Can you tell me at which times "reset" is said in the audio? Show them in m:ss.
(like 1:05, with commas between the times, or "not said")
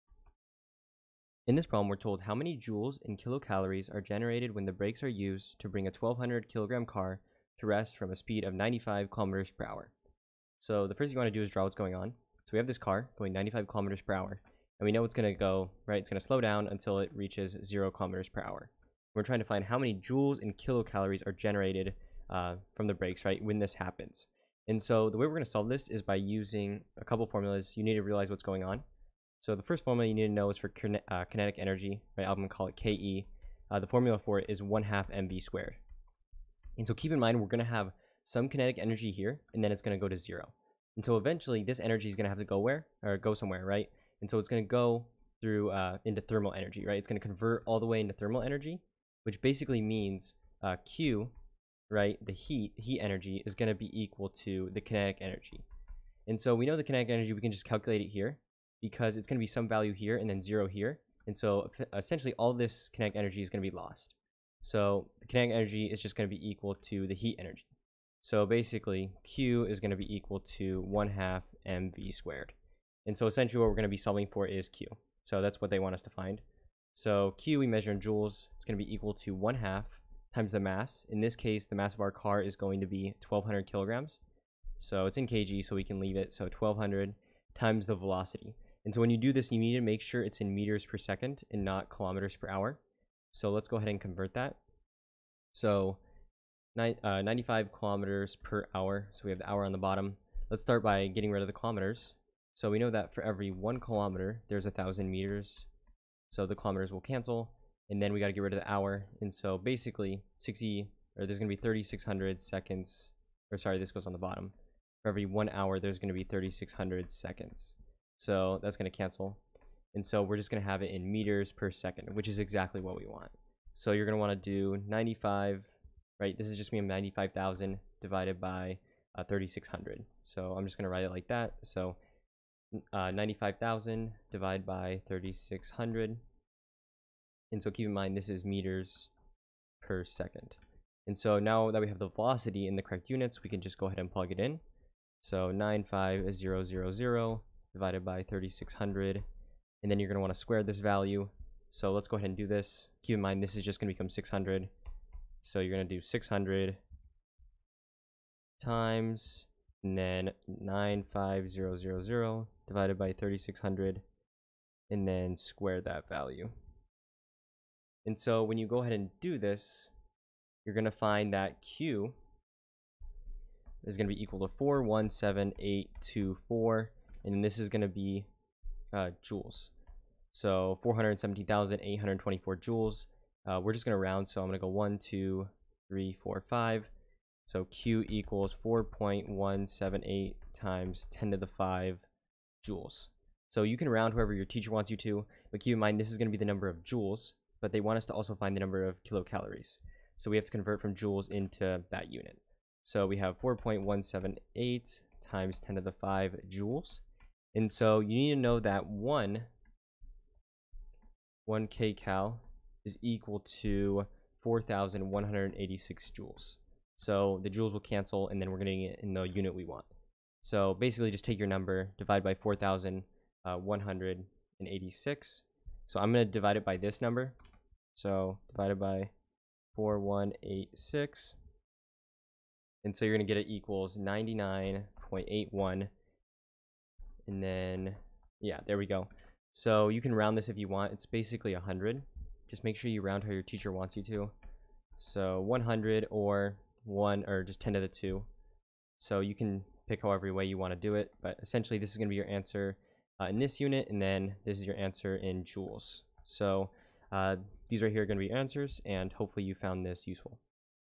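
not said.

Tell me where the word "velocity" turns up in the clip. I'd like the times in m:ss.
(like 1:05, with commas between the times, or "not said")
1:27, 2:22.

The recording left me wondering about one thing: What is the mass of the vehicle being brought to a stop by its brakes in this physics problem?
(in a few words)
1200 kg.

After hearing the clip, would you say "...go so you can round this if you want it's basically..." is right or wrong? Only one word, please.
right.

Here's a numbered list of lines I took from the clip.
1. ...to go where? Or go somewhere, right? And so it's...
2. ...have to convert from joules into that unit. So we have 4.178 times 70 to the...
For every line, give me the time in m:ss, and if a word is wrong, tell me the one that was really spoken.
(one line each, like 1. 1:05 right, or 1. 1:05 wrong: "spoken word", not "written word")
1. 0:42 right
2. 3:20 wrong: "10", not "70".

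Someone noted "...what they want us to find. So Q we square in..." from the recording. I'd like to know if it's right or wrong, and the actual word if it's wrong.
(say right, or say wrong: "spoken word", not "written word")
wrong: "measure", not "square".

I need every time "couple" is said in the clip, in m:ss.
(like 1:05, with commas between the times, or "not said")
0:27.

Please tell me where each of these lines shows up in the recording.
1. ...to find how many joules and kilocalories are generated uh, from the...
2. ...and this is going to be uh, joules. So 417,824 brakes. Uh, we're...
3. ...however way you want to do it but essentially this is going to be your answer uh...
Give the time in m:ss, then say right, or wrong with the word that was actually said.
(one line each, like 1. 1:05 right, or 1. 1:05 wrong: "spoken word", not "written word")
1. 0:19 right
2. 2:57 wrong: "joules", not "brakes"
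3. 4:10 right.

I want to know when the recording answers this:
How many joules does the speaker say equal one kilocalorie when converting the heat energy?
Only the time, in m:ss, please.
3:34.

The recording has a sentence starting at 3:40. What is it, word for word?
So basically, just take your number, divide by 4,186.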